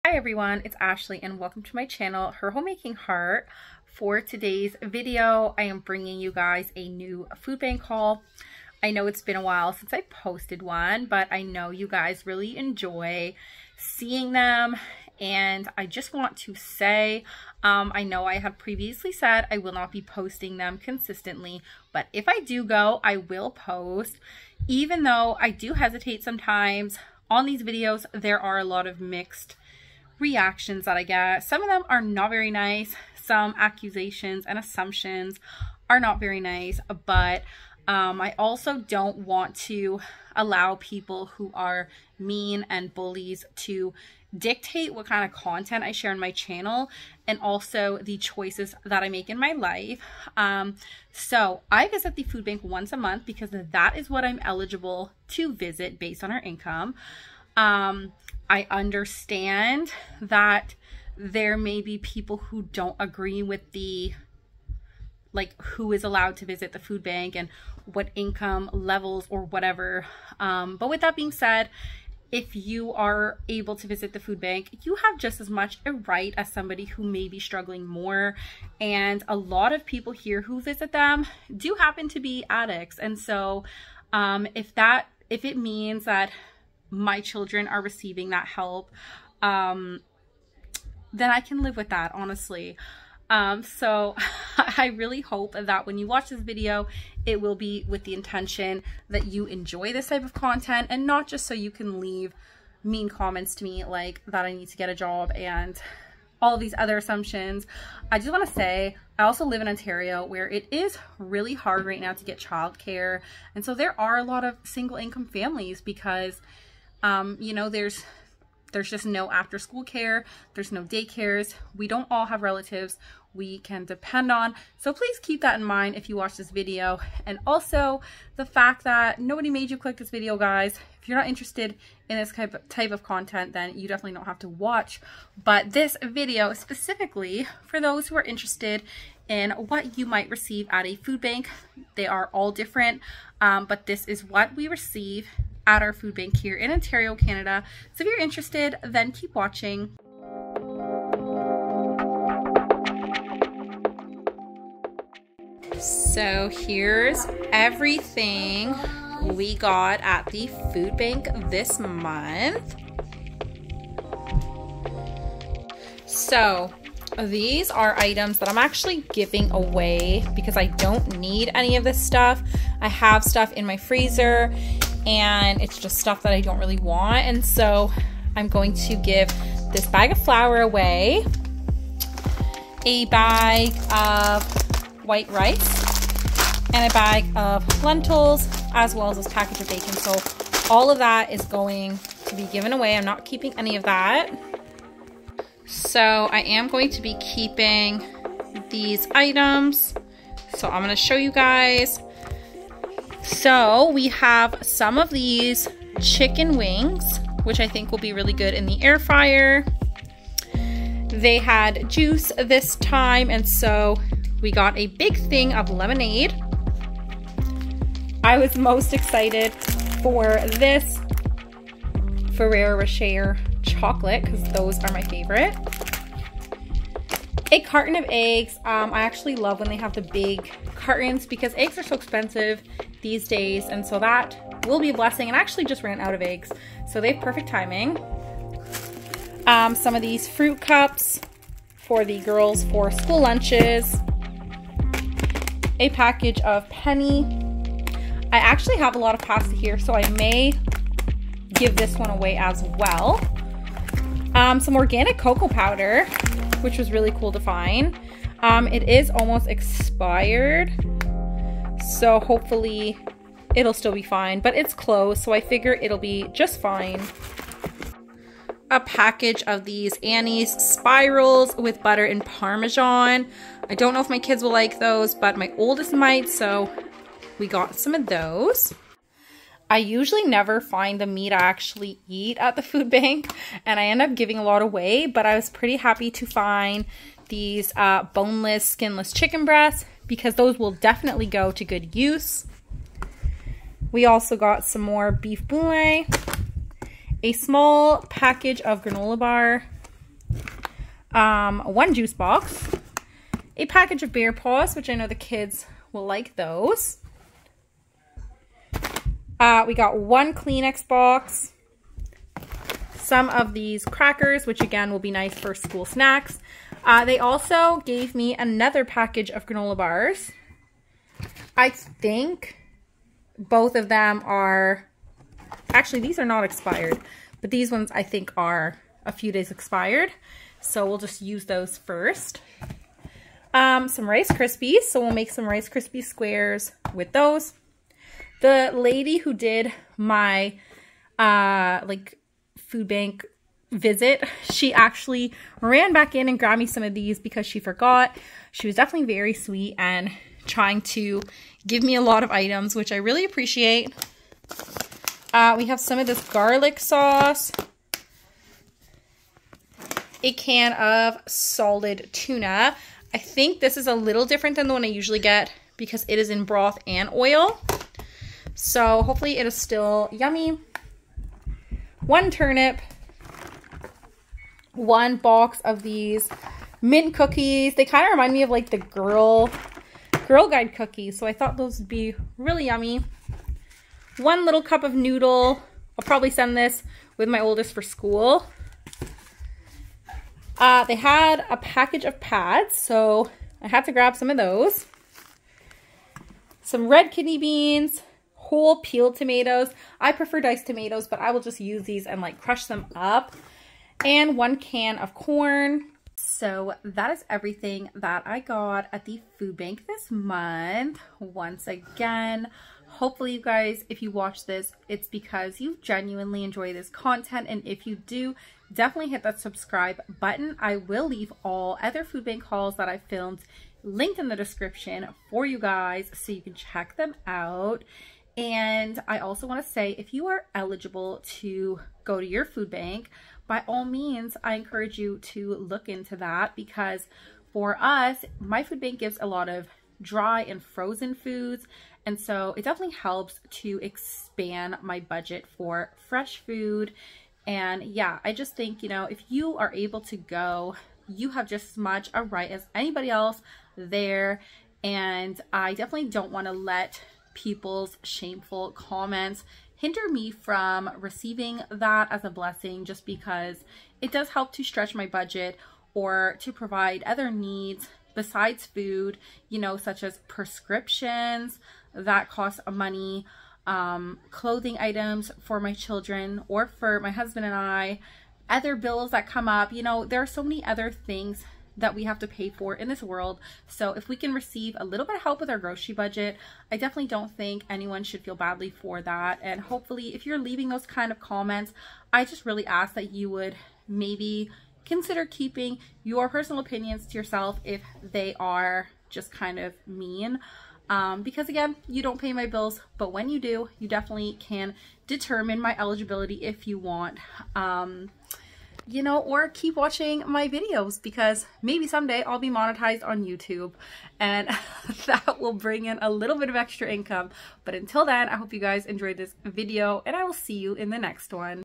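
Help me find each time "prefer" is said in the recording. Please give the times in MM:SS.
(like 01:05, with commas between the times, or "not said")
06:40.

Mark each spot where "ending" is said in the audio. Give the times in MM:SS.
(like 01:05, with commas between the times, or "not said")
not said.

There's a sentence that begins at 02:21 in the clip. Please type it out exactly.
They are all different, um, but this is what we receive at our food bank here in Ontario, Canada.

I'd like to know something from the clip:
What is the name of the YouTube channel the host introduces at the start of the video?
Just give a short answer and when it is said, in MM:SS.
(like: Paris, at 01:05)
Her Homemaking Heart, at 00:02.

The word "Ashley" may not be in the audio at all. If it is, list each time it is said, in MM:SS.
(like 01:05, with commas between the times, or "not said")
00:00.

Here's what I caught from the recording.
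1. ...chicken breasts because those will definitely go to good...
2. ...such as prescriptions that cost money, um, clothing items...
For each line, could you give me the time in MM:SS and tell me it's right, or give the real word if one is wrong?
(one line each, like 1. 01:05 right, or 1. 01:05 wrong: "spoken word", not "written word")
1. 04:49 right
2. 07:49 right.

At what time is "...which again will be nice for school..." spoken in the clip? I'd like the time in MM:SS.
05:14.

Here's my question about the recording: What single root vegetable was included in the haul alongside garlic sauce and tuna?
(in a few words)
Turnip.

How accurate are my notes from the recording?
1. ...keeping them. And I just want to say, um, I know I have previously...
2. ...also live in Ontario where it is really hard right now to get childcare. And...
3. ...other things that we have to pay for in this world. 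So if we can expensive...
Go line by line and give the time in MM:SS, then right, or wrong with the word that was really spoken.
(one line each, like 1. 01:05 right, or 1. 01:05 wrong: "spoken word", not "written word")
1. 00:13 wrong: "seeing", not "keeping"
2. 01:49 right
3. 08:00 wrong: "receive", not "expensive".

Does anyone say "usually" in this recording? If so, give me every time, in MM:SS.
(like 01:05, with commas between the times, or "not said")
04:39, 06:04.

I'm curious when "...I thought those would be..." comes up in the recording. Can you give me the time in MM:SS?
06:21.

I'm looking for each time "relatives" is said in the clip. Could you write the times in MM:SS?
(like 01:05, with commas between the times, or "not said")
02:02.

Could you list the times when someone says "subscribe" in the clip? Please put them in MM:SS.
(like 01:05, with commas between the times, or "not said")
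06:59.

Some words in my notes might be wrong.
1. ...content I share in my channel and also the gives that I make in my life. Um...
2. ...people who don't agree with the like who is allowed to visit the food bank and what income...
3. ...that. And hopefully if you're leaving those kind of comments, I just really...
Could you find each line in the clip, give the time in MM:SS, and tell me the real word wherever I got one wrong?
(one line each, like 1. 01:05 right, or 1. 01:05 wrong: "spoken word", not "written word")
1. 00:45 wrong: "choices", not "gives"
2. 01:01 right
3. 08:09 right.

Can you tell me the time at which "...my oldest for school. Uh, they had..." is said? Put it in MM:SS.
06:27.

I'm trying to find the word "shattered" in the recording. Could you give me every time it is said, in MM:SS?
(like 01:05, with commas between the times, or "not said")
not said.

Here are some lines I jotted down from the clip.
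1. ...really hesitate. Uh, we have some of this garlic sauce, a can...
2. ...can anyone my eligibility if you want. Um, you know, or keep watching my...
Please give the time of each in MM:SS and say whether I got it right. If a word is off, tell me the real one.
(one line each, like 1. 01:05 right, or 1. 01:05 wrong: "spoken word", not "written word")
1. 05:52 wrong: "appreciate", not "hesitate"
2. 08:24 wrong: "determine", not "anyone".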